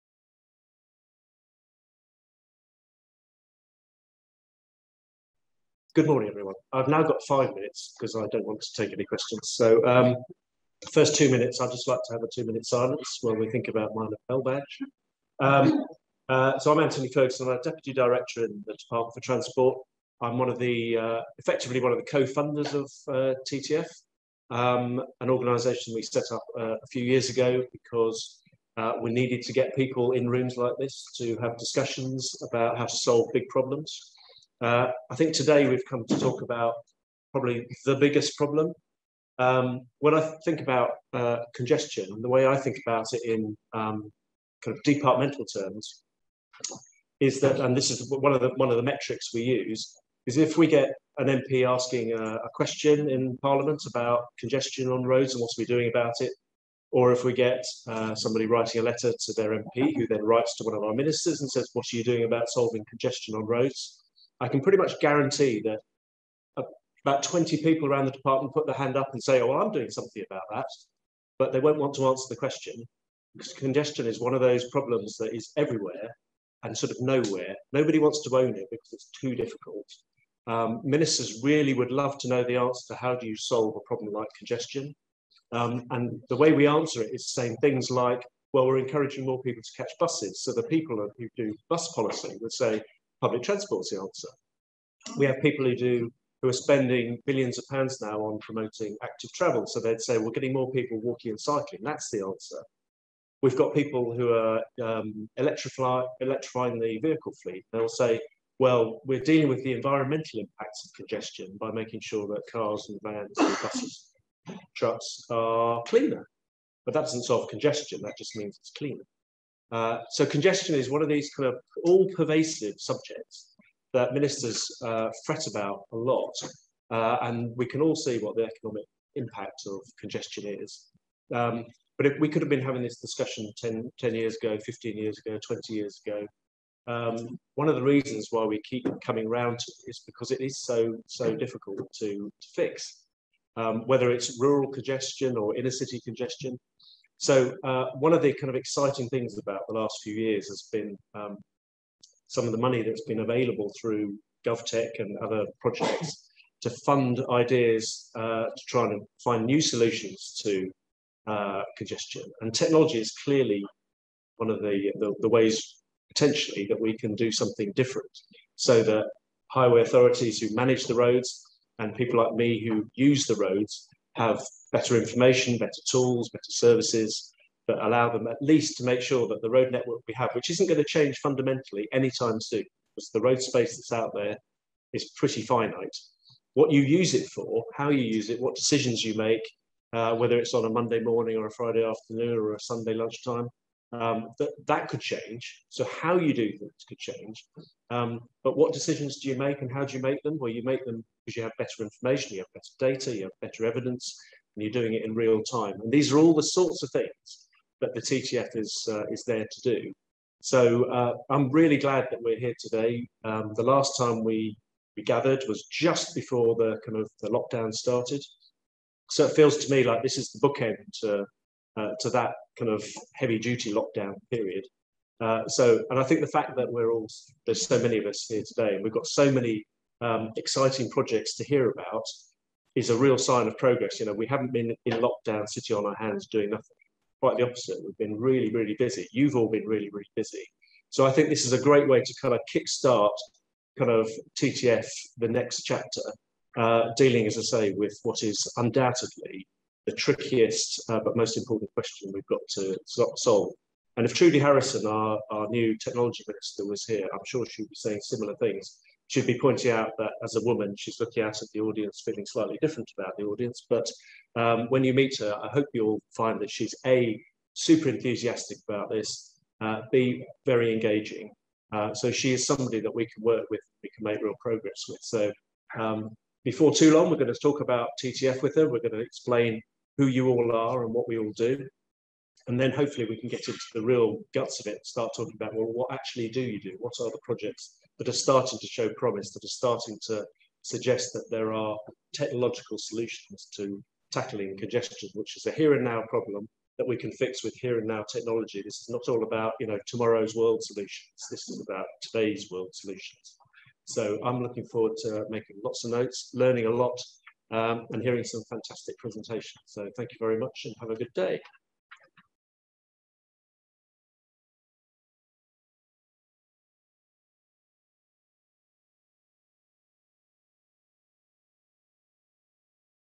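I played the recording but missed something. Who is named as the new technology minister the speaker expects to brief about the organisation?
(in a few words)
Trudy Harrison.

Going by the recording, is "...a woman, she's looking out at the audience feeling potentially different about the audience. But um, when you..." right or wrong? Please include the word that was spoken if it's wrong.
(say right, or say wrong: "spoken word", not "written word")
wrong: "slightly", not "potentially".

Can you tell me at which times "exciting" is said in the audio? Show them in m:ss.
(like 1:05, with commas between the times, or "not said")
2:28, 3:50.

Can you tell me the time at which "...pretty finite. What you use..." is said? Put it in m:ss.
3:05.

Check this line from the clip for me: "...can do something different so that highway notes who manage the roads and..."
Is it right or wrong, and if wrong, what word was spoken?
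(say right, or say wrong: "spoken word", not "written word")
wrong: "authorities", not "notes".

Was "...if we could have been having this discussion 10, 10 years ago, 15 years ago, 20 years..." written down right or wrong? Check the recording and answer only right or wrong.
right.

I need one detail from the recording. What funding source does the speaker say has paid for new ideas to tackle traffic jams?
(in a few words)
GovTech.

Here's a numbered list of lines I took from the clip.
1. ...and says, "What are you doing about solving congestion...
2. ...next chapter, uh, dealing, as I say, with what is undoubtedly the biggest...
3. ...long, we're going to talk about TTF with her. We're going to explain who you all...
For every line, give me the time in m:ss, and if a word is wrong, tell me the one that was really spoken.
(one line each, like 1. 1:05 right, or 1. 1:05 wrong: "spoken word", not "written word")
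1. 1:01 right
2. 4:05 wrong: "trickiest", not "biggest"
3. 4:36 right.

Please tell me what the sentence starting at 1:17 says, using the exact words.
Nobody wants to own it because it's too difficult.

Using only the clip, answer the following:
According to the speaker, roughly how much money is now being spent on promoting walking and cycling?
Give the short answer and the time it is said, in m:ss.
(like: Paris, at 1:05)
billions of pounds, at 1:37.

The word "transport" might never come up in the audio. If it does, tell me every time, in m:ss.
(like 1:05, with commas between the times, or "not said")
0:19, 1:33.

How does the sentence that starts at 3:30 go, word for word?
So uh, I'm really glad that we're here today.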